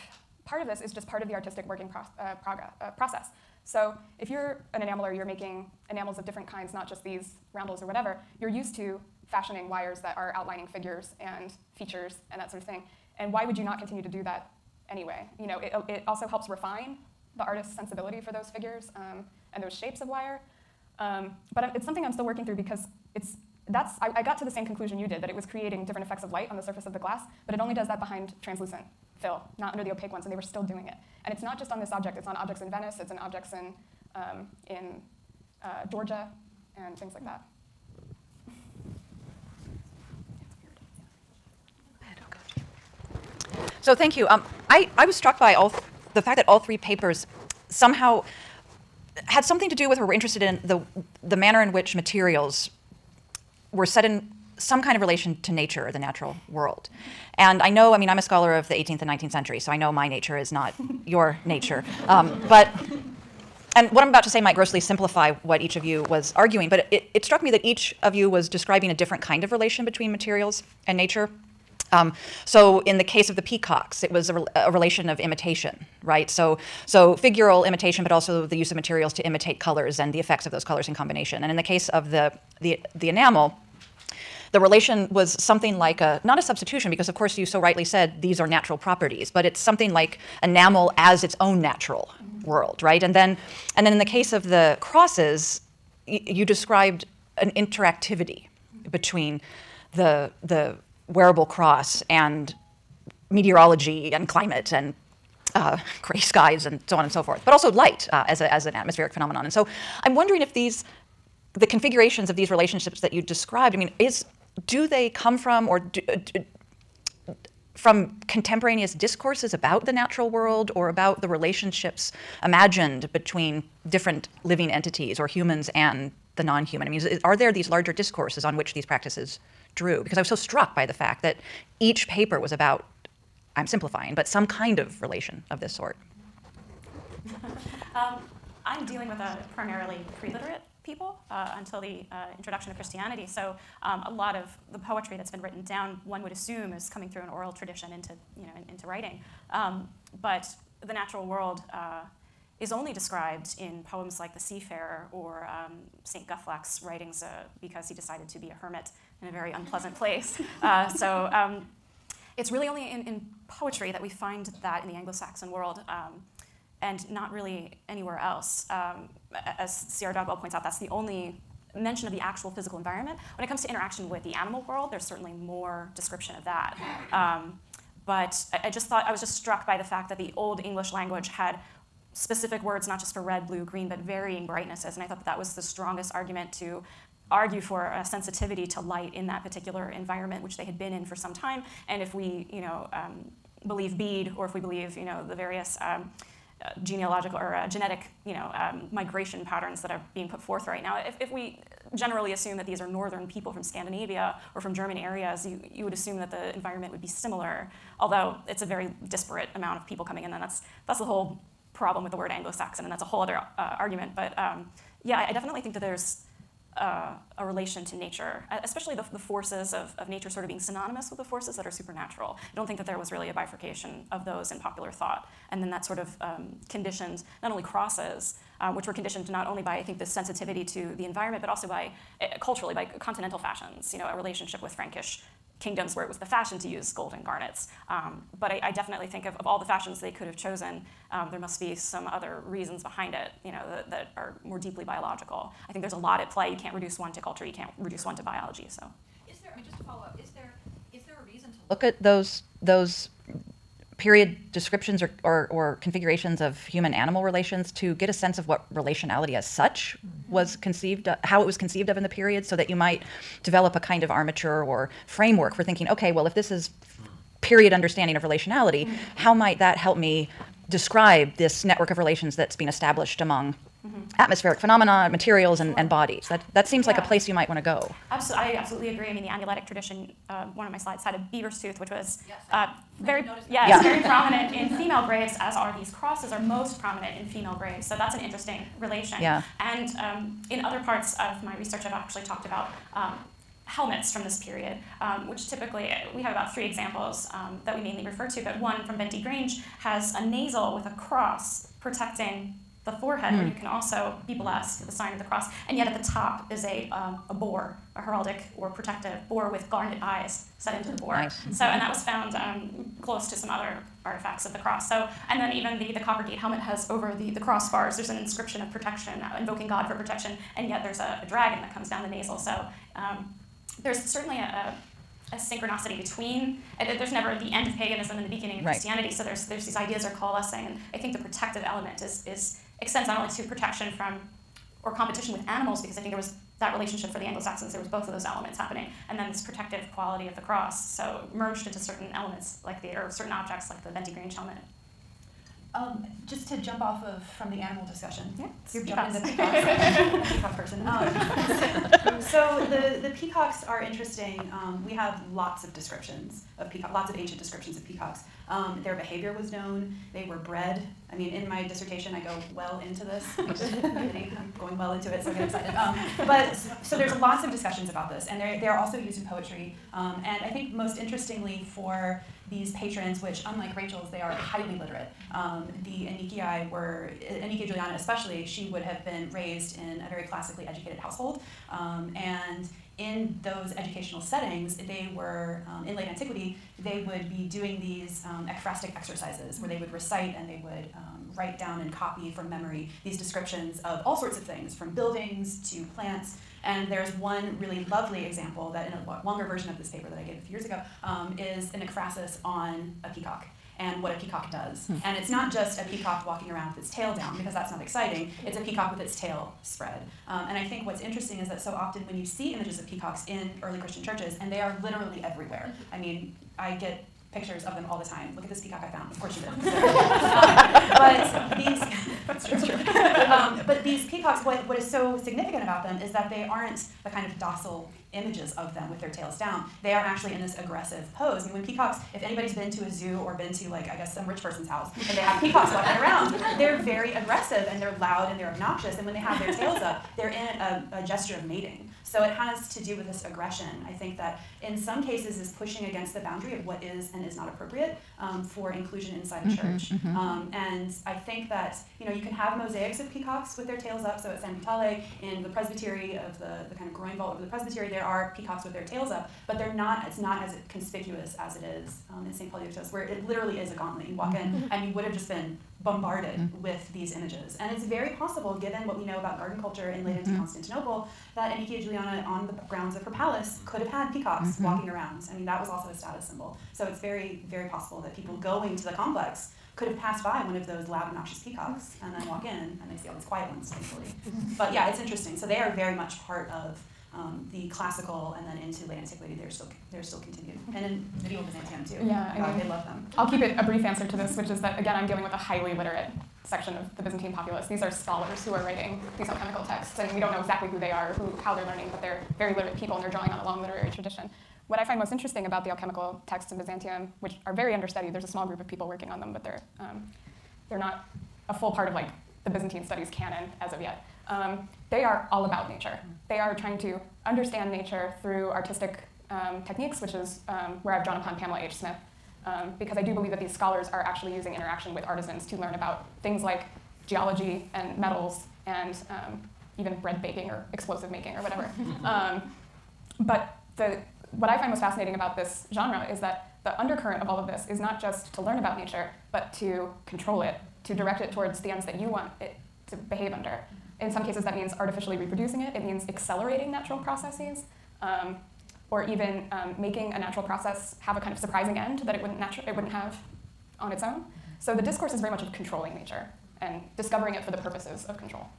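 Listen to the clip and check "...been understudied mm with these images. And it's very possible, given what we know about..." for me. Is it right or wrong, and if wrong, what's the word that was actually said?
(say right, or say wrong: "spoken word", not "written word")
wrong: "bombarded", not "understudied".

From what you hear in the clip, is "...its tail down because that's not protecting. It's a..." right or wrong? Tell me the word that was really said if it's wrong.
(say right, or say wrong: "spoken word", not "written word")
wrong: "exciting", not "protecting".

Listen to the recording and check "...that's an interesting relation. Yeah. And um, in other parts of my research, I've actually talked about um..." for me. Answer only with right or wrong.
right.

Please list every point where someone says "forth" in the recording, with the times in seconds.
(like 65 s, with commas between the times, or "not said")
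107 s, 200 s.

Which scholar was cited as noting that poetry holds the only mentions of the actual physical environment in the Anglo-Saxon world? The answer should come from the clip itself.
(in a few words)
C. R. Dodwell.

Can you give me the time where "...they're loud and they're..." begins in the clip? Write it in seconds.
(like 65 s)
437 s.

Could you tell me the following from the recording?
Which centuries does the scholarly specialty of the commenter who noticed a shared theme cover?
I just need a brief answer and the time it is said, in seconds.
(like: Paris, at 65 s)
18th and 19th century, at 58 s.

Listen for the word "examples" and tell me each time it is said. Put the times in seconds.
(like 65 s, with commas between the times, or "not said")
296 s, 398 s.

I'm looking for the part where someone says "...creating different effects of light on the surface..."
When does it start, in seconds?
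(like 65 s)
25 s.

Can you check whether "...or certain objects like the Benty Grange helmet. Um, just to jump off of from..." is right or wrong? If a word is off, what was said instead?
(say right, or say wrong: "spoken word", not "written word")
right.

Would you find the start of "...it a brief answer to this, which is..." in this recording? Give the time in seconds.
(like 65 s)
493 s.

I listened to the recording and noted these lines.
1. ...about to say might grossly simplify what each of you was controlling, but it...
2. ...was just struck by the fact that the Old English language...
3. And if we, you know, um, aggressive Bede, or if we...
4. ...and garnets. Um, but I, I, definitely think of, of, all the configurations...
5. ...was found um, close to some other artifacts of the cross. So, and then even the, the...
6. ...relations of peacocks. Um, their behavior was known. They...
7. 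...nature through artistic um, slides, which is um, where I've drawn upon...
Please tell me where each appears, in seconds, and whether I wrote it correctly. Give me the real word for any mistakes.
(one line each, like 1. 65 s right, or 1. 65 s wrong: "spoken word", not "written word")
1. 64 s wrong: "arguing", not "controlling"
2. 179 s right
3. 191 s wrong: "believe", not "aggressive"
4. 237 s wrong: "fashions", not "configurations"
5. 311 s right
6. 357 s wrong: "descriptions", not "relations"
7. 517 s wrong: "techniques", not "slides".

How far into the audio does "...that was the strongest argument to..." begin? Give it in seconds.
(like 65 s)
185 s.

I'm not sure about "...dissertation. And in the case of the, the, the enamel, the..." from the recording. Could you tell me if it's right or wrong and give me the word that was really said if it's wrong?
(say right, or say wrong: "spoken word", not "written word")
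wrong: "combination", not "dissertation".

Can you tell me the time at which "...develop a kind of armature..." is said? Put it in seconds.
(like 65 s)
263 s.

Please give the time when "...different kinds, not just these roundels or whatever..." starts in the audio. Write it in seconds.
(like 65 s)
6 s.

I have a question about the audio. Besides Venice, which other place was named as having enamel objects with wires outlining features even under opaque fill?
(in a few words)
Georgia.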